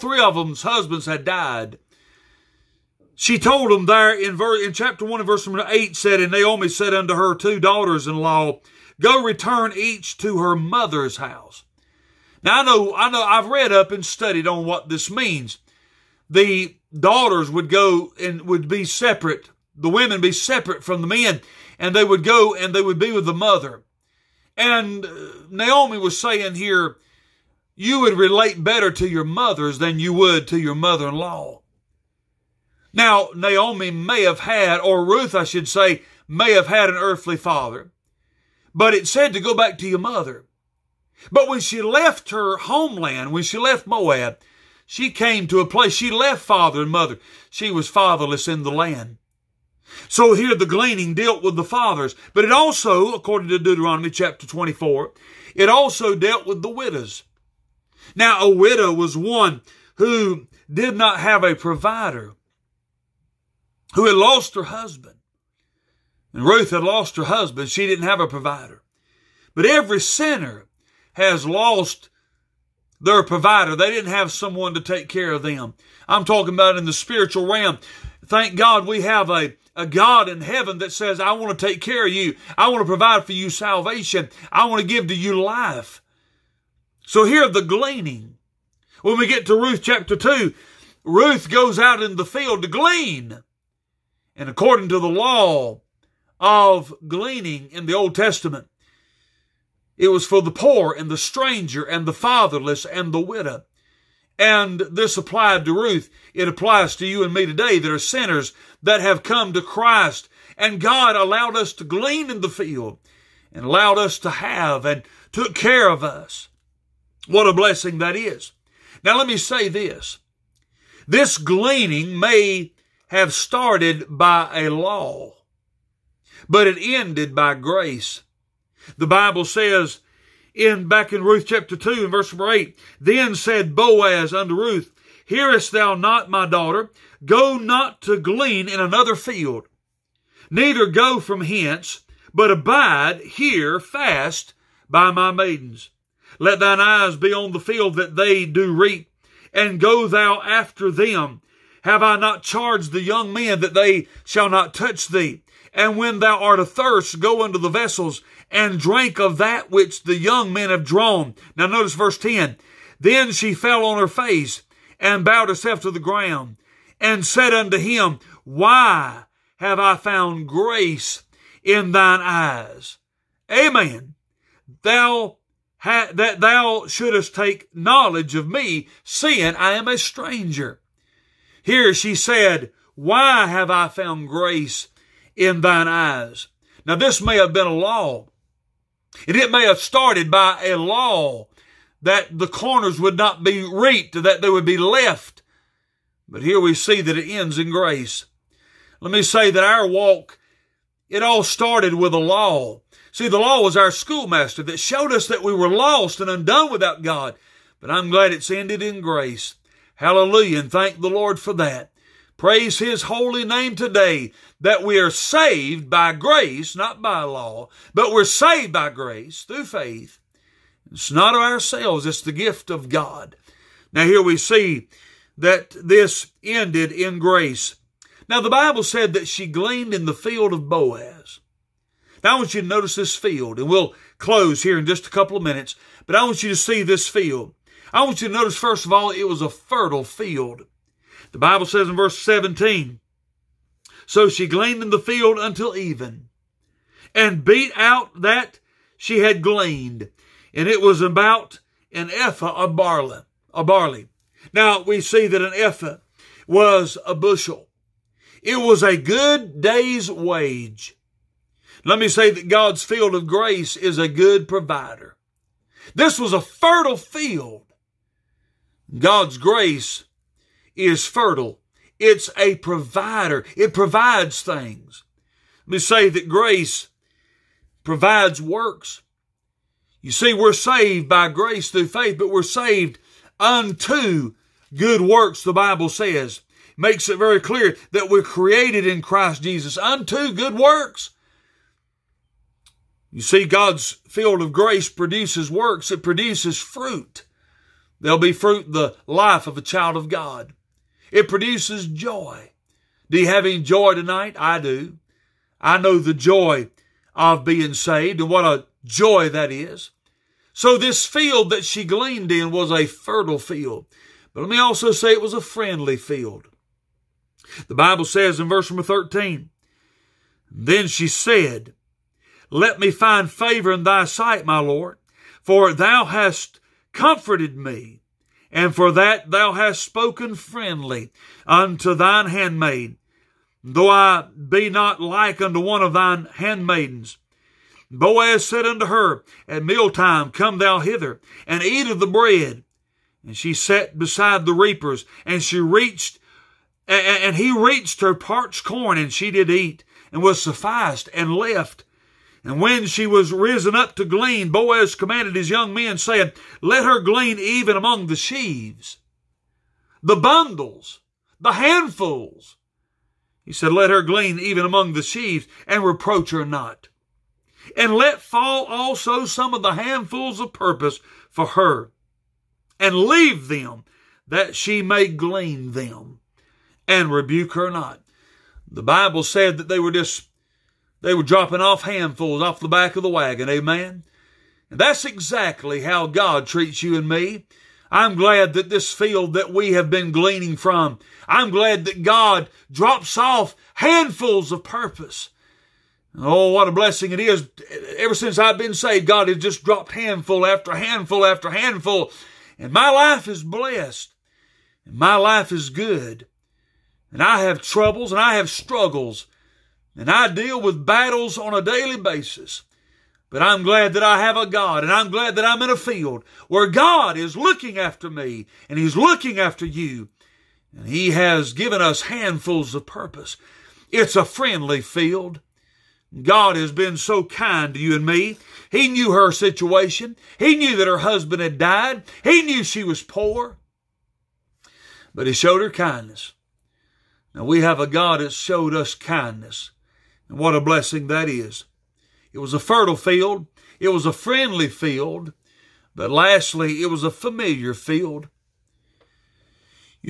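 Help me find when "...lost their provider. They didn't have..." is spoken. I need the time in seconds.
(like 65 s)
71 s.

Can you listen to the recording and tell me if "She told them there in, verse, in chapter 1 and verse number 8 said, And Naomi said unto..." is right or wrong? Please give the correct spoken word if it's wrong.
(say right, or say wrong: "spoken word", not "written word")
right.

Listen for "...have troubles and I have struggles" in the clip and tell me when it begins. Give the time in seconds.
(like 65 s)
407 s.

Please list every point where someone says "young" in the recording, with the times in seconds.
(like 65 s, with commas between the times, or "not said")
153 s, 160 s, 355 s.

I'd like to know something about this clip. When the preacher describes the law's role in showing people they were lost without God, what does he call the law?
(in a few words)
Our schoolmaster.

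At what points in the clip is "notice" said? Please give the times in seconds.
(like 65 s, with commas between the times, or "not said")
161 s, 232 s, 238 s.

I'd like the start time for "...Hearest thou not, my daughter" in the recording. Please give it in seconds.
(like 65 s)
135 s.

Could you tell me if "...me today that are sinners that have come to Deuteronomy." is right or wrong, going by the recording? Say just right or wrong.
wrong.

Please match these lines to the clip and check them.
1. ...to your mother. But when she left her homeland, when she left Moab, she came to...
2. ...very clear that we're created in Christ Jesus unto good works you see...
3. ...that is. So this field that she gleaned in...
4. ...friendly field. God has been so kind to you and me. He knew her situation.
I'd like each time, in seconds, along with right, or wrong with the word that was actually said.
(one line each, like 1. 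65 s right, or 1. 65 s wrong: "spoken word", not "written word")
1. 39 s right
2. 287 s right
3. 309 s right
4. 424 s right.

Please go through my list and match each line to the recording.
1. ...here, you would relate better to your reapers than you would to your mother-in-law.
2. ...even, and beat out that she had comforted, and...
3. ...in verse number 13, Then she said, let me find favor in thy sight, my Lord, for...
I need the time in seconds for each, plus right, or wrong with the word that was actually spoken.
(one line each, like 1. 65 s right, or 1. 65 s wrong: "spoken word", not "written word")
1. 26 s wrong: "mothers", not "reapers"
2. 245 s wrong: "gleaned", not "comforted"
3. 318 s right.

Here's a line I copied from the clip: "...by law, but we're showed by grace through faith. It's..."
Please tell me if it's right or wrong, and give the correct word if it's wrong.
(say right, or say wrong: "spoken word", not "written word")
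wrong: "saved", not "showed".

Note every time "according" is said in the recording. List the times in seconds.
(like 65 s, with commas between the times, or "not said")
53 s, 94 s.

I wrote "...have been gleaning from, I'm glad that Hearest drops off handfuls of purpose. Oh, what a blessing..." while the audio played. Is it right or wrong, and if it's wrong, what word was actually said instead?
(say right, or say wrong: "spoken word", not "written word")
wrong: "God", not "Hearest".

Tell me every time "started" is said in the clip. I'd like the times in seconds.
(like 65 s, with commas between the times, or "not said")
123 s, 189 s, 201 s.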